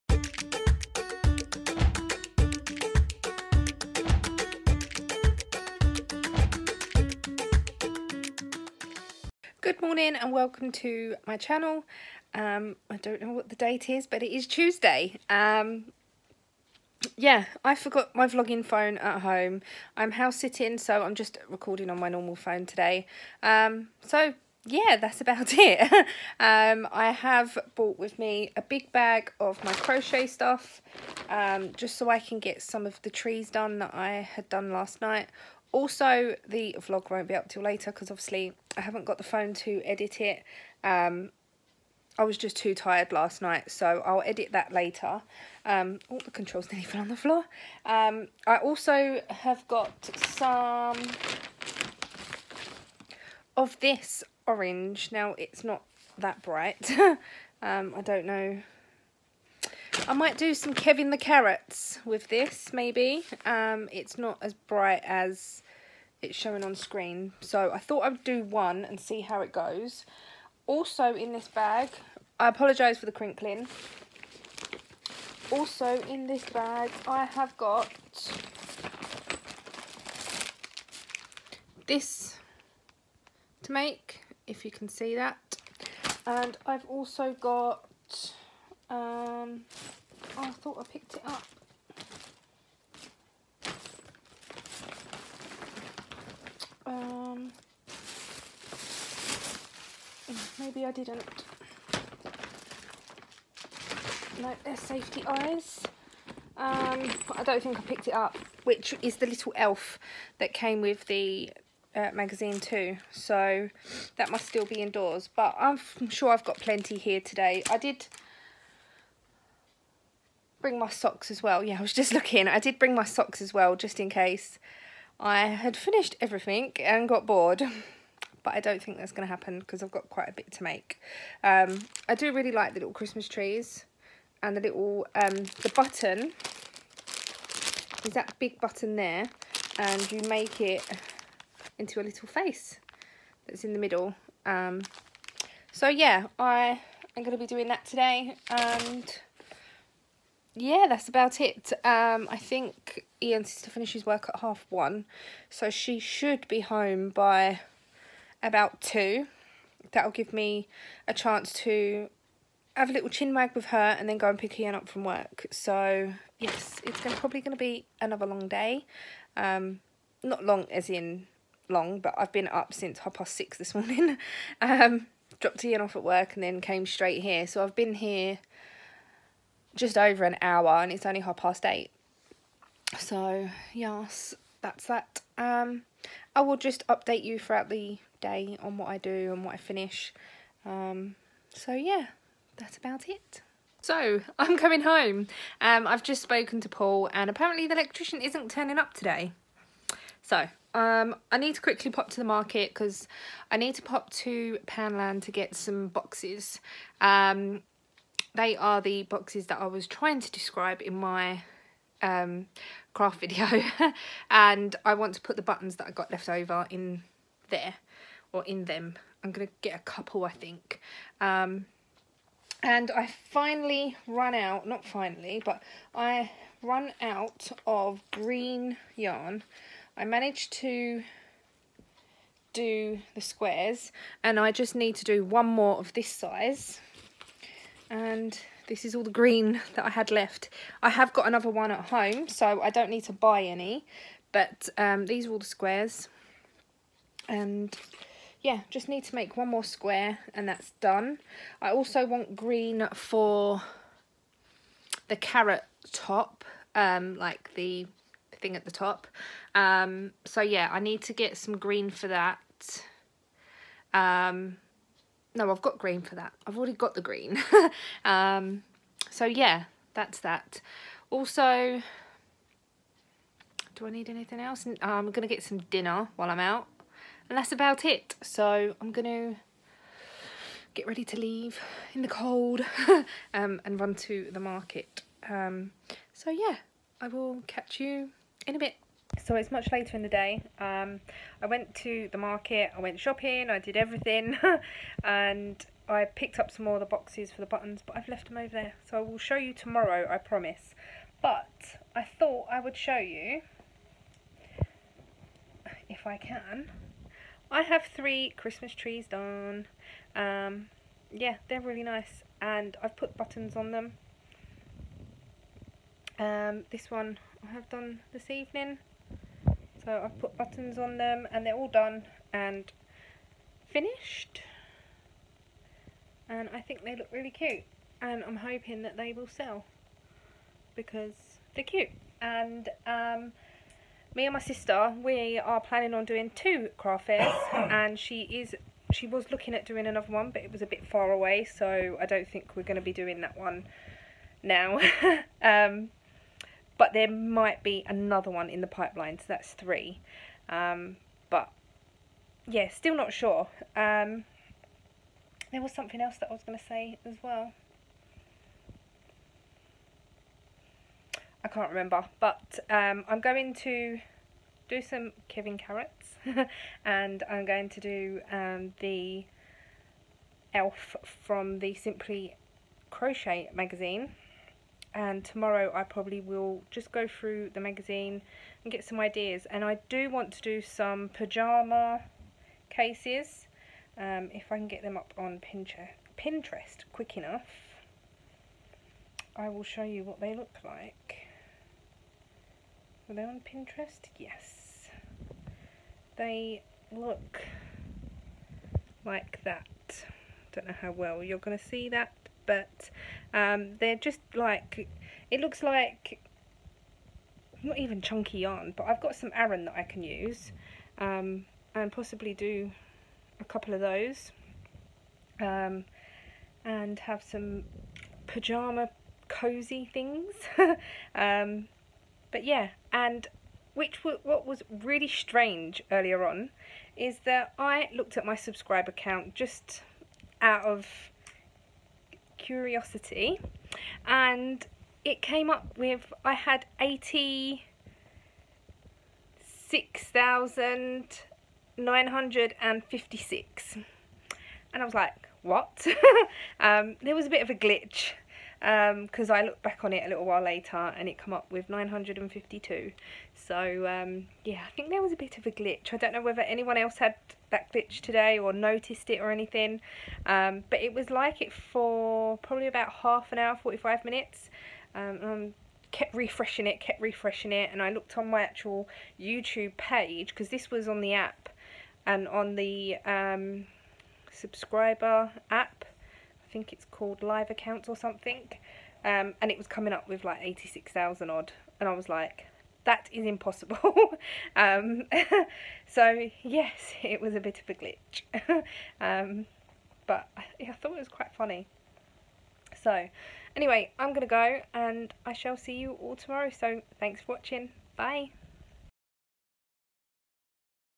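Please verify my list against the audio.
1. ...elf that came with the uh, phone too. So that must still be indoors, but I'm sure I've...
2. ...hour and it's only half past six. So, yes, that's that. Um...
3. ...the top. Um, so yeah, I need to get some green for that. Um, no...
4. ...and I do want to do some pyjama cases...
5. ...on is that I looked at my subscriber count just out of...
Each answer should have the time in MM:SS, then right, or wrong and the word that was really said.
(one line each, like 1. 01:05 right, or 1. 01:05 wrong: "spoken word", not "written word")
1. 01:49 wrong: "magazine", not "phone"
2. 03:00 wrong: "eight", not "six"
3. 04:18 right
4. 06:19 right
5. 07:06 right.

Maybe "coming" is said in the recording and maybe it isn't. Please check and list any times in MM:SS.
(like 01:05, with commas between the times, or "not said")
03:14, 07:59.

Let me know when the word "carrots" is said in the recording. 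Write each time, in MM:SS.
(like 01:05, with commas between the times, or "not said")
01:01, 04:15, 06:05.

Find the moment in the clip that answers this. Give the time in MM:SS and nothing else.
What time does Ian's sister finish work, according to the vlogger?
02:34.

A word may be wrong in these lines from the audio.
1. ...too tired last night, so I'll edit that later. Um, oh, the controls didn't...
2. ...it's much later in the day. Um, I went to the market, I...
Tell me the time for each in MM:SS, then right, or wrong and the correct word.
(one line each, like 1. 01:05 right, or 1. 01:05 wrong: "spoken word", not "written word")
1. 00:42 right
2. 04:49 right.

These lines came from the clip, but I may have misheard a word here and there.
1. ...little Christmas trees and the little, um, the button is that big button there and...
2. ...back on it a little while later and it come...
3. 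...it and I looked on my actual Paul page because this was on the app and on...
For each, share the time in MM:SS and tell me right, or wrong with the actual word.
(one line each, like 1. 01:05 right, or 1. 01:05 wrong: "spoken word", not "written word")
1. 02:12 right
2. 07:29 right
3. 07:47 wrong: "YouTube", not "Paul".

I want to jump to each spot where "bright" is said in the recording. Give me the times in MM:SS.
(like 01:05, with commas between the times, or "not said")
00:56, 01:04.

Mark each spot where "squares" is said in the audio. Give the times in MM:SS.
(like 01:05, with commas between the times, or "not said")
03:53, 04:05, 04:09.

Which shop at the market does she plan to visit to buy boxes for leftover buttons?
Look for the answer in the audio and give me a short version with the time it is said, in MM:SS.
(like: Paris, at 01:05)
Poundland, at 03:24.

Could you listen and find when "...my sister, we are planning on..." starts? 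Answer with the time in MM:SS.
05:34.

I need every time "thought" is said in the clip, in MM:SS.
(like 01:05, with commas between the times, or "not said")
01:07, 01:30, 05:02, 08:10.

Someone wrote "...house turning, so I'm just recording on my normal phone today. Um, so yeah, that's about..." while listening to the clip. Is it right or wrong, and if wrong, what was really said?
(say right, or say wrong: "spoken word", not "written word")
wrong: "sitting", not "turning".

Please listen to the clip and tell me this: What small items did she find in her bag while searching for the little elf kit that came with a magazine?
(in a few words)
Safety eyes.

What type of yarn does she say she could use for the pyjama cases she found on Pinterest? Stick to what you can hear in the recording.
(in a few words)
Aran.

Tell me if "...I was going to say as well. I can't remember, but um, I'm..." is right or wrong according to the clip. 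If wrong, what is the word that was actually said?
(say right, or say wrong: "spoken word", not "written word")
right.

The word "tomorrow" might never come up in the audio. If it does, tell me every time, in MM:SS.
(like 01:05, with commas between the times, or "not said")
04:59, 06:15, 08:16.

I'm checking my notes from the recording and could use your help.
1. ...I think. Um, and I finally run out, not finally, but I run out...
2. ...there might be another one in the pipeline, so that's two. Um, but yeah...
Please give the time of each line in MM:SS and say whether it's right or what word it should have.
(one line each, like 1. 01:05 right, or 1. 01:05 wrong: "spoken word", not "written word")
1. 03:40 right
2. 05:46 wrong: "three", not "two".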